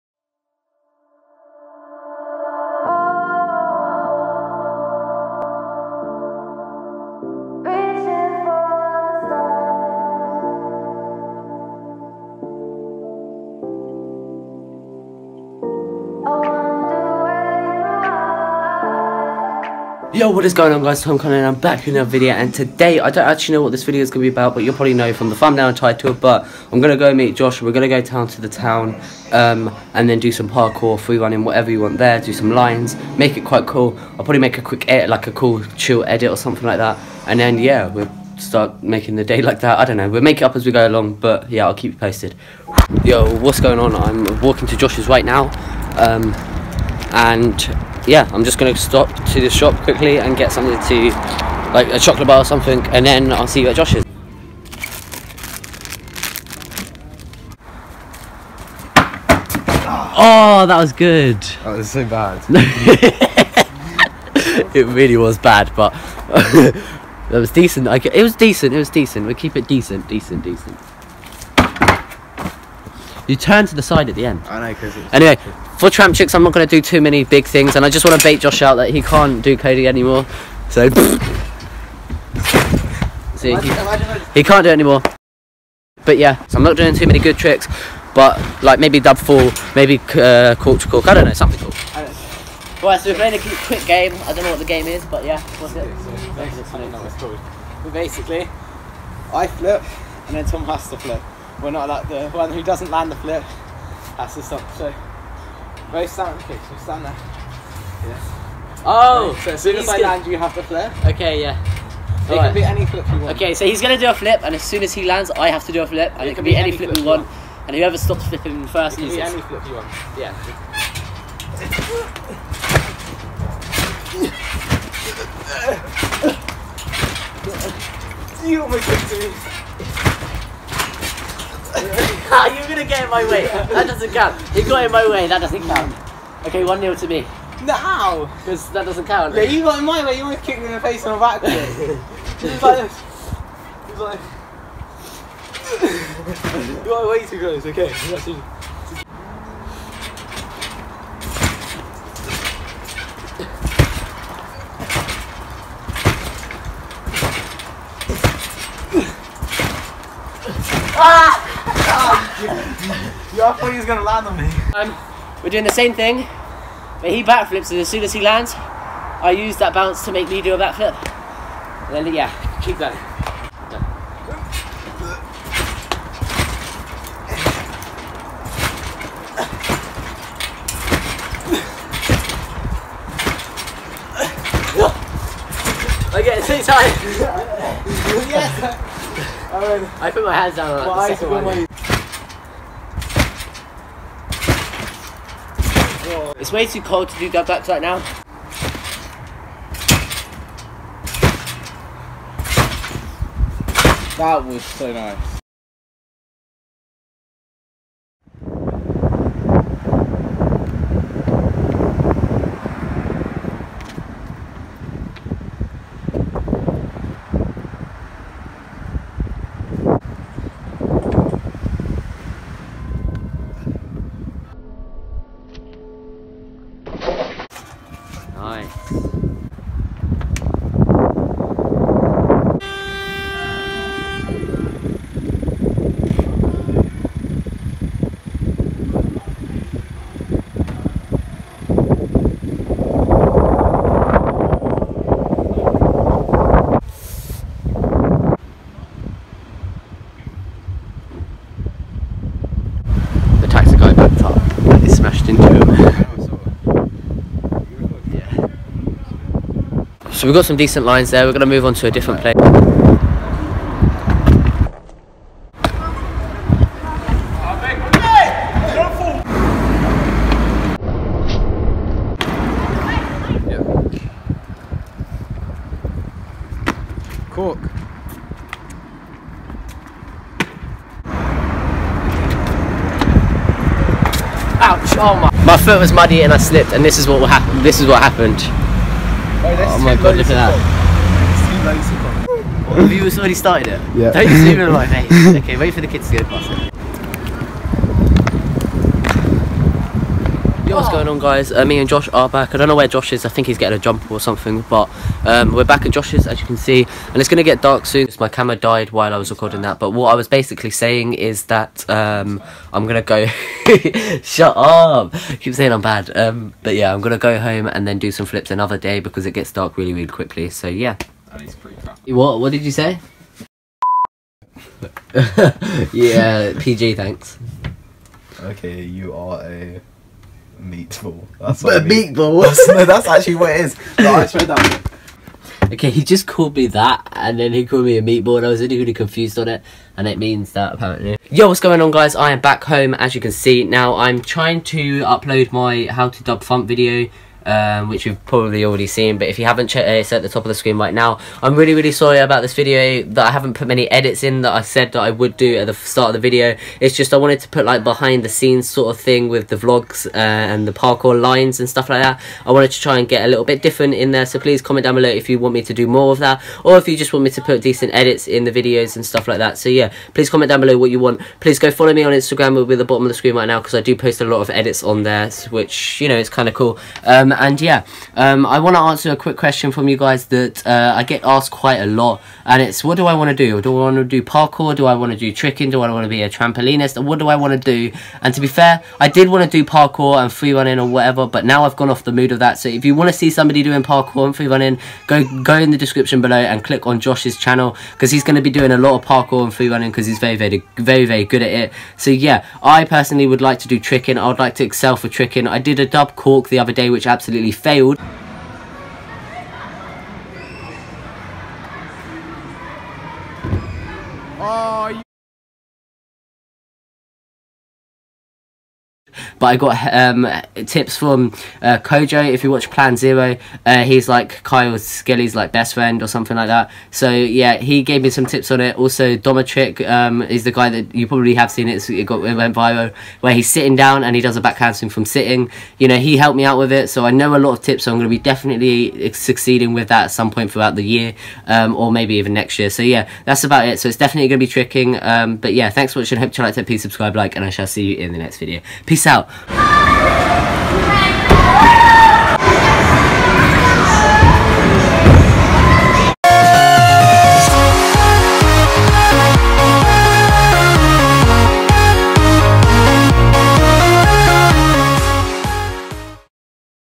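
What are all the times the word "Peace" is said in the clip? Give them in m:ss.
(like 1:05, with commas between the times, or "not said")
7:28.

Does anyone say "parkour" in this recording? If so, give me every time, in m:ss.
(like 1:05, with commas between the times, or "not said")
0:30, 6:00, 6:24, 6:29, 6:33, 6:39.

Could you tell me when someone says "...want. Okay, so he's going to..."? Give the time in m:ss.
1:53.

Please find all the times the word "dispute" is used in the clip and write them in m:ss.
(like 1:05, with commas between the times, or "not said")
not said.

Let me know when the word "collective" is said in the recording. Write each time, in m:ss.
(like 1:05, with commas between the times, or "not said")
not said.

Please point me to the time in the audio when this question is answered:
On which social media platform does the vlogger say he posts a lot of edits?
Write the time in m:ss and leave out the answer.
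6:12.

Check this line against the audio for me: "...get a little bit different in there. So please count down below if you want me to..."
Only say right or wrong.
wrong.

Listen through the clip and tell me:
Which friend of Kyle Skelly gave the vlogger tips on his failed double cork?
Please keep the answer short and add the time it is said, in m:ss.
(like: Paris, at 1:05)
Kojo, at 7:01.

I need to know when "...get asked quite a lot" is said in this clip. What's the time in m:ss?
6:21.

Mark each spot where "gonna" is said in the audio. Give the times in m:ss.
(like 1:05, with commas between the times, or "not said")
0:48, 1:49, 2:12, 2:43.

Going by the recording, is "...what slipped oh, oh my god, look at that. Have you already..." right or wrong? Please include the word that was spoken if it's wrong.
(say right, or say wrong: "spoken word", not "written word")
wrong: "happened", not "slipped".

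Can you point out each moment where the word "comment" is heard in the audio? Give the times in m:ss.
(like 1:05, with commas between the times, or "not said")
6:04, 6:10.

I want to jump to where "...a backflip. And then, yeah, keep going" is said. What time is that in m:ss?
2:50.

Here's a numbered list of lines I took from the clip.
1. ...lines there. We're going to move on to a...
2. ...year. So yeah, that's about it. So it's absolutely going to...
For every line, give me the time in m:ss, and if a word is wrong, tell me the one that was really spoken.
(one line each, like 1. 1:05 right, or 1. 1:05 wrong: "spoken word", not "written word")
1. 4:20 right
2. 7:22 wrong: "definitely", not "absolutely".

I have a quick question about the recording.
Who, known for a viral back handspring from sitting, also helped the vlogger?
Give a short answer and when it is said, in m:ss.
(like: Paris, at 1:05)
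Domatrick, at 7:09.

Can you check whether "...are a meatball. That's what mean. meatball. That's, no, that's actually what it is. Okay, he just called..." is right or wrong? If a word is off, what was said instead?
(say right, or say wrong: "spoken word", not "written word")
right.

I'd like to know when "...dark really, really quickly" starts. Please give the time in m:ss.
5:19.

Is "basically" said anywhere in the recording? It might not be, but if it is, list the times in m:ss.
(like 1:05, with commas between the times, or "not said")
1:37, 5:10.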